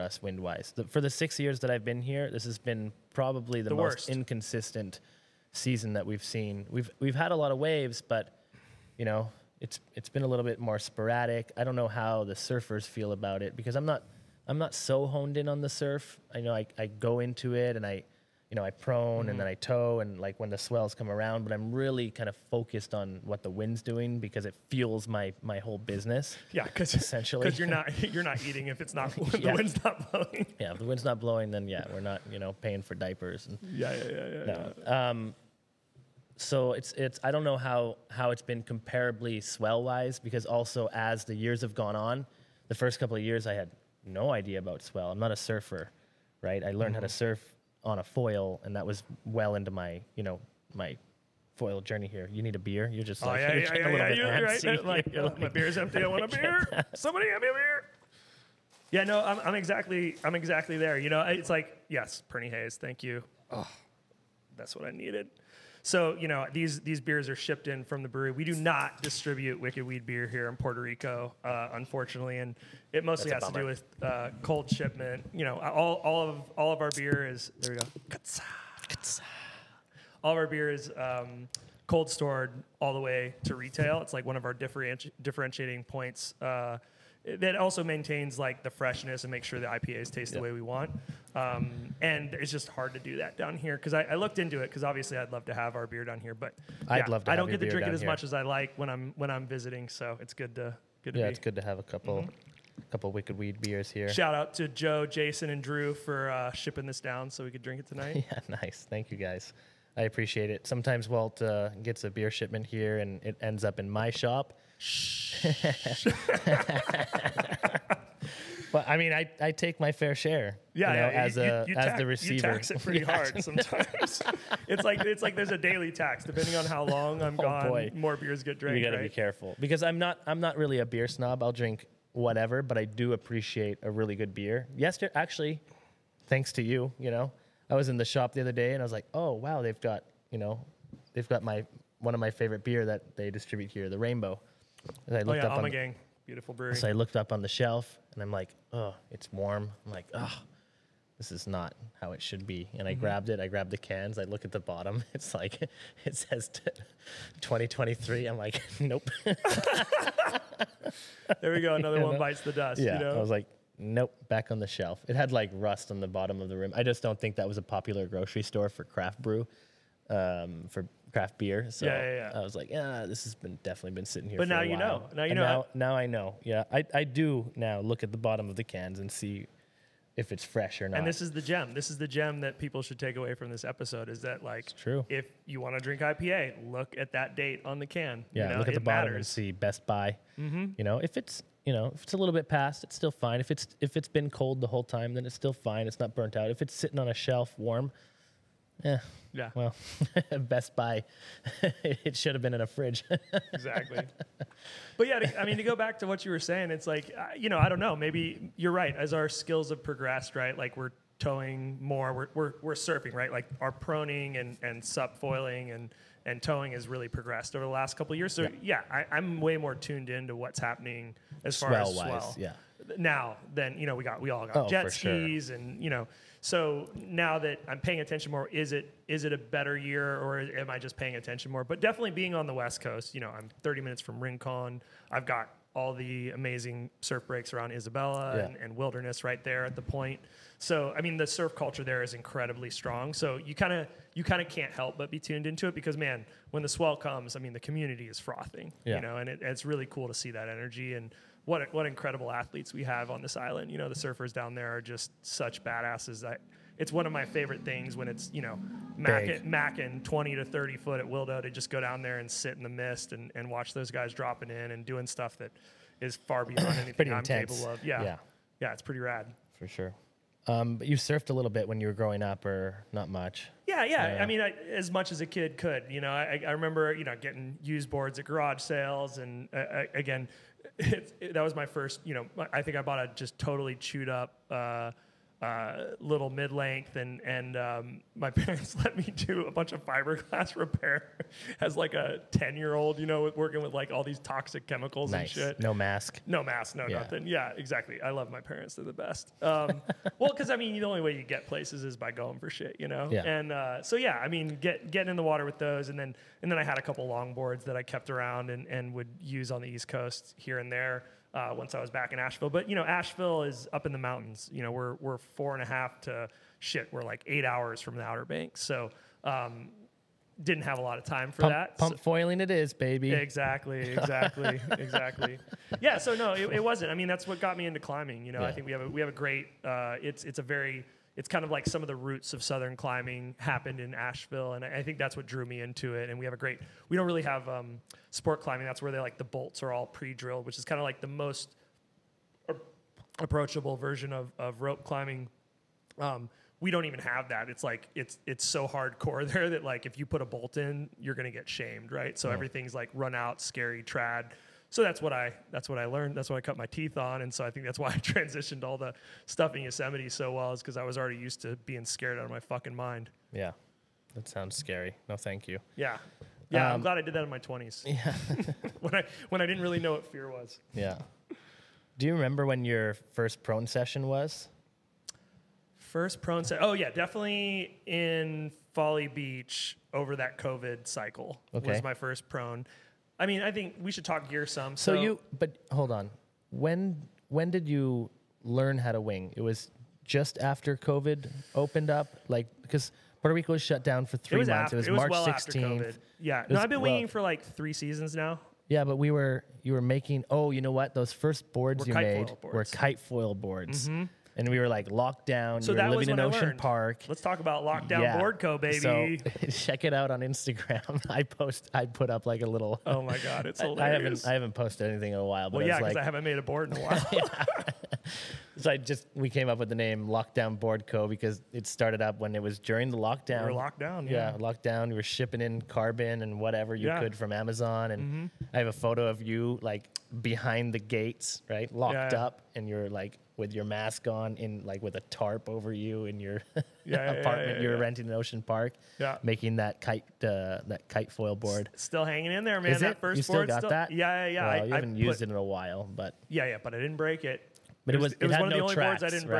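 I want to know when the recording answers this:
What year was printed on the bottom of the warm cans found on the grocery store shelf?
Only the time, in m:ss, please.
2:37.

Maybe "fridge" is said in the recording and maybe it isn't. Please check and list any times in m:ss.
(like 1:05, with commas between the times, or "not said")
3:22.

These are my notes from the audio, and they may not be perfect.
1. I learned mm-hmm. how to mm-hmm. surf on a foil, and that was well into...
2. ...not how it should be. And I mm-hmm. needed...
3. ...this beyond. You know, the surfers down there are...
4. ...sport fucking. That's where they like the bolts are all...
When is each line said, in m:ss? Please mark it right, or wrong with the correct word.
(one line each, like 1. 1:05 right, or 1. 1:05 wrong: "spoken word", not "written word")
1. 0:46 right
2. 2:31 wrong: "grabbed", not "needed"
3. 4:13 wrong: "island", not "beyond"
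4. 5:38 wrong: "climbing", not "fucking".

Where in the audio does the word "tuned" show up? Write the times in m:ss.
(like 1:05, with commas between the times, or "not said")
3:39, 4:05.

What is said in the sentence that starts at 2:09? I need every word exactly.
be careful because I'm not I'm not really a beer snob.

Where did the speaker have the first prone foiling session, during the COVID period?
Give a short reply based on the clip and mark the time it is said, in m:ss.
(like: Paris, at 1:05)
Folly Beach, at 6:18.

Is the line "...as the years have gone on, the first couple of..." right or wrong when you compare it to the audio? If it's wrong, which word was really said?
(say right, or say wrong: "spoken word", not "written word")
right.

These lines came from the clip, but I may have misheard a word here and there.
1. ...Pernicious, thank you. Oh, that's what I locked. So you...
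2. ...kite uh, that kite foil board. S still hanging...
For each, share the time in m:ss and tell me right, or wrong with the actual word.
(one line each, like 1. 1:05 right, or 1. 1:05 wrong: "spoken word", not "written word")
1. 1:02 wrong: "needed", not "locked"
2. 7:19 right.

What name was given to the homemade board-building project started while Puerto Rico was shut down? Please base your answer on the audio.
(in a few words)
Lockdown Board Co.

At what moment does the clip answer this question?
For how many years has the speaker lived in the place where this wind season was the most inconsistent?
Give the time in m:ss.
0:01.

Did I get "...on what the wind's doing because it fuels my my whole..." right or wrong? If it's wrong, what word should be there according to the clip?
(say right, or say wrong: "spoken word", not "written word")
right.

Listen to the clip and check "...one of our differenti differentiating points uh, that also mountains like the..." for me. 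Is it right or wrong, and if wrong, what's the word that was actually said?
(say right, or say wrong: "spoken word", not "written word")
wrong: "maintains", not "mountains".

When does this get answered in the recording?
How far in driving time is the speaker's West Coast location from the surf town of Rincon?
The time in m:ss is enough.
3:53.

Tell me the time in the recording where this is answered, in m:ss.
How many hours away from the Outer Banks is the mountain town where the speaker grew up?
5:17.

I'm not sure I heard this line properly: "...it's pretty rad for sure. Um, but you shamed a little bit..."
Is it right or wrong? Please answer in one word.
wrong.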